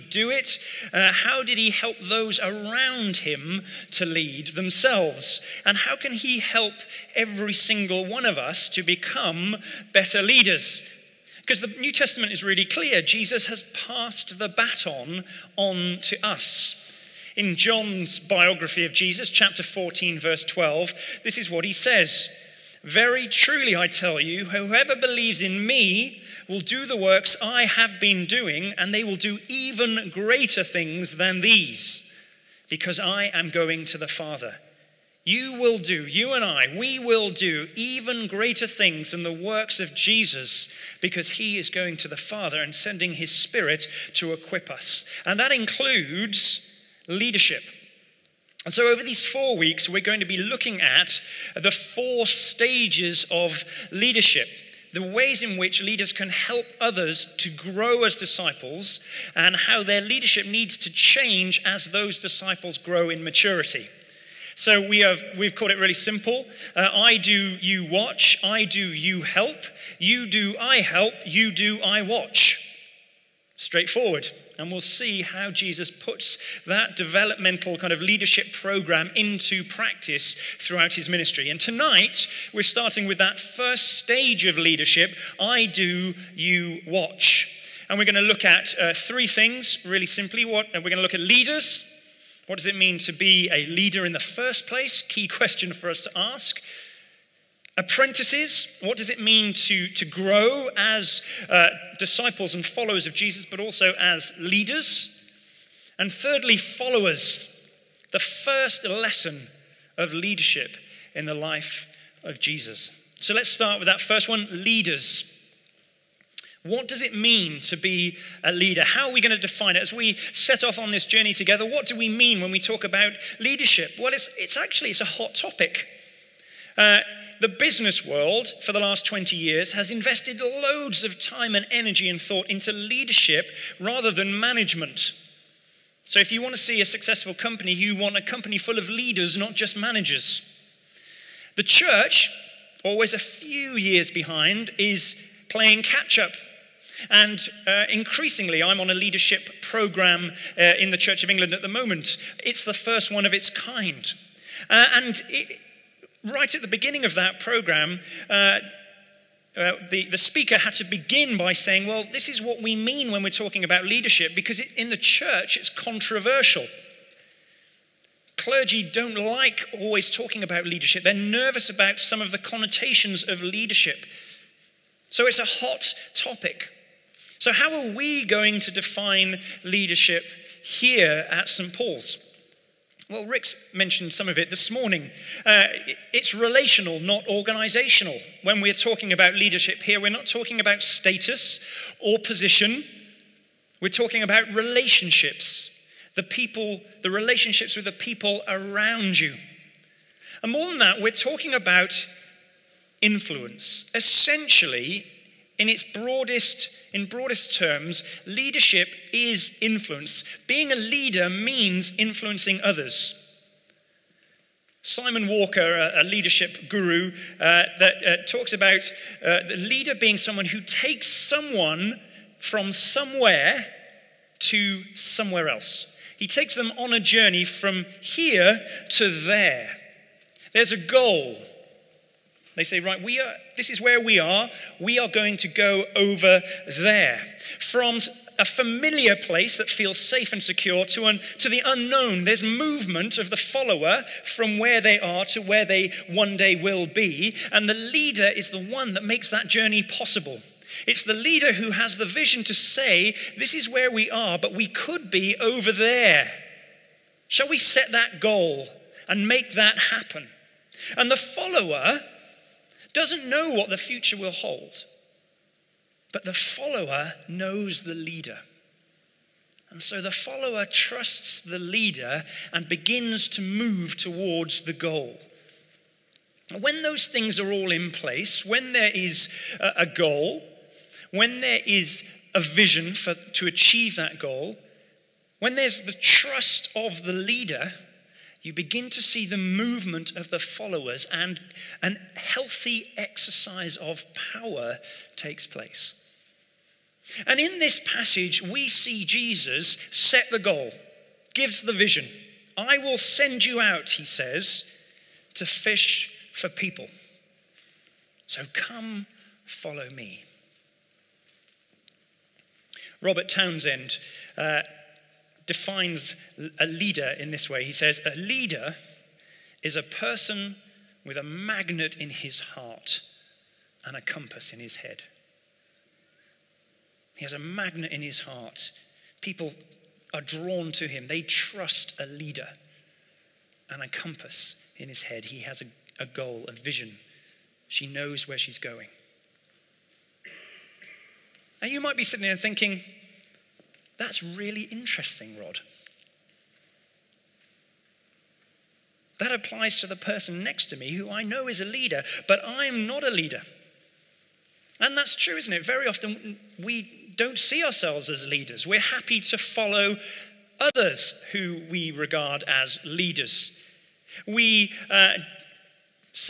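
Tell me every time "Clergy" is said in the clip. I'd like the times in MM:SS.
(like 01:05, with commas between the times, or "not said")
02:48.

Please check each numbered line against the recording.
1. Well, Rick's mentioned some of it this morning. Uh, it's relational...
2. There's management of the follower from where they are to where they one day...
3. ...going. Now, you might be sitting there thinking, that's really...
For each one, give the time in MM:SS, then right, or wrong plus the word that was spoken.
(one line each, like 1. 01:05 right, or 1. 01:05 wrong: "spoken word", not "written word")
1. 03:03 right
2. 04:02 wrong: "movement", not "management"
3. 05:38 right.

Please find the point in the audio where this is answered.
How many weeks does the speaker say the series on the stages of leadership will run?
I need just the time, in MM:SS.
00:49.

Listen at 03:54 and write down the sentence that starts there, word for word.
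We are going to go over there.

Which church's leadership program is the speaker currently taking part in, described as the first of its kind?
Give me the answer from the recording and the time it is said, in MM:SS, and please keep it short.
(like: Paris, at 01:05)
Church of England, at 02:30.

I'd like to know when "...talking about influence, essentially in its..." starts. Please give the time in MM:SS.
03:21.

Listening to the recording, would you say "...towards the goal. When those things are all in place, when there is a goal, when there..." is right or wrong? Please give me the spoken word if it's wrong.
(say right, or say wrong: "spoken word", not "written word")
right.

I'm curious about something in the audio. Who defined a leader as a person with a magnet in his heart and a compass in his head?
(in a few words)
Robert Townsend.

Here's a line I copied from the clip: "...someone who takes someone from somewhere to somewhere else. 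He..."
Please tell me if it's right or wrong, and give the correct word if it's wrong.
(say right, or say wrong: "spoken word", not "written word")
right.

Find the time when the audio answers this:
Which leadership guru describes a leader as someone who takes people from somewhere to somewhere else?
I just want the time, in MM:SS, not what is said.
03:34.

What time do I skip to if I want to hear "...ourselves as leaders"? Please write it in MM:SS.
05:57.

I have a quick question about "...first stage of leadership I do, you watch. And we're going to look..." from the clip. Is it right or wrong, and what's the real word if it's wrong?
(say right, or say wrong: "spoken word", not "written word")
right.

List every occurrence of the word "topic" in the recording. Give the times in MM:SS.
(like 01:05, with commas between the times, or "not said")
02:05, 02:56.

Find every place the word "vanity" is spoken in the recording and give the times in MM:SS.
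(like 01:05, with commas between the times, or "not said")
not said.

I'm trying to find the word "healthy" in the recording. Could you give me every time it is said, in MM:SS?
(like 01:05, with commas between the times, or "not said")
04:52.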